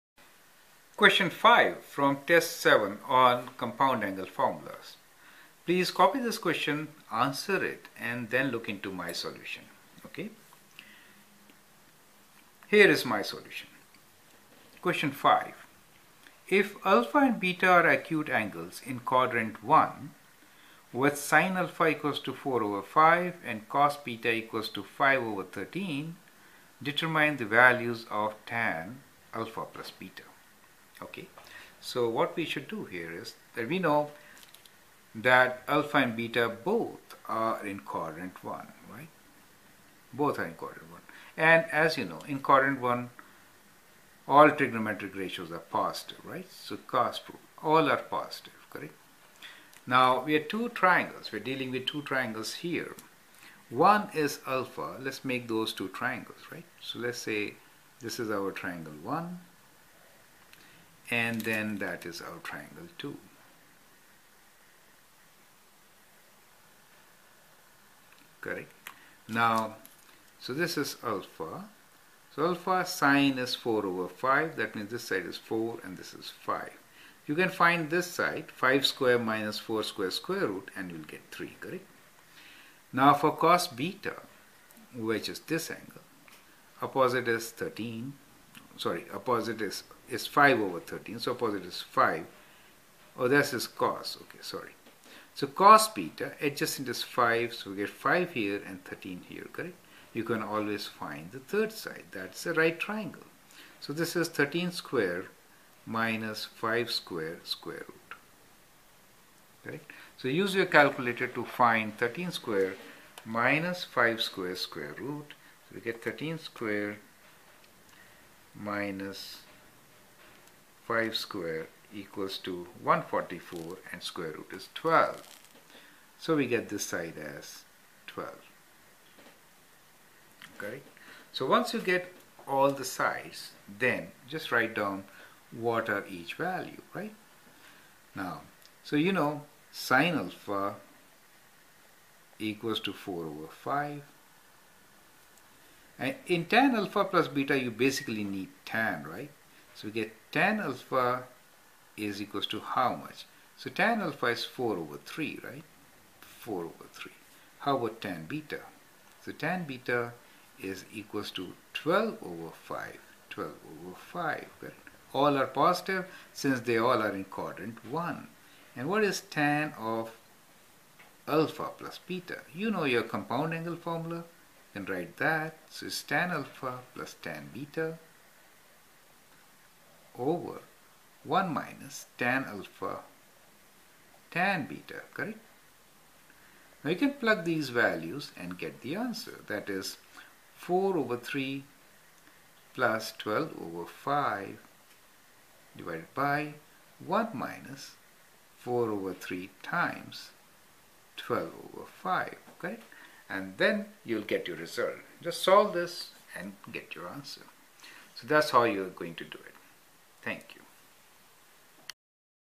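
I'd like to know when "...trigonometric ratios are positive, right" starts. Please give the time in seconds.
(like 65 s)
44 s.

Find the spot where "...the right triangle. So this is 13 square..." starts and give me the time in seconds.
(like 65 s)
102 s.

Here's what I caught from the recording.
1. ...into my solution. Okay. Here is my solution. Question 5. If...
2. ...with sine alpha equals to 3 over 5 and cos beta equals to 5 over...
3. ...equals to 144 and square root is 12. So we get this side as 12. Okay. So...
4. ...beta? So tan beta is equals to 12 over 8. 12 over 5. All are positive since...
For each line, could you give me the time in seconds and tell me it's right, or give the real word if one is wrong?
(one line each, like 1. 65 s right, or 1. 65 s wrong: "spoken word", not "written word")
1. 8 s right
2. 20 s wrong: "4", not "3"
3. 121 s right
4. 158 s wrong: "5", not "8".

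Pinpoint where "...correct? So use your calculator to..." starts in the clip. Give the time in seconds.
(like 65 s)
109 s.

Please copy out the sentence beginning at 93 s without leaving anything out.
Oh, that's is cos, okay, sorry.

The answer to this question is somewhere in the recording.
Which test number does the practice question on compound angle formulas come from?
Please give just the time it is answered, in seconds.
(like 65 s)
2 s.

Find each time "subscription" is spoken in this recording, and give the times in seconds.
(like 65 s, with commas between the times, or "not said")
not said.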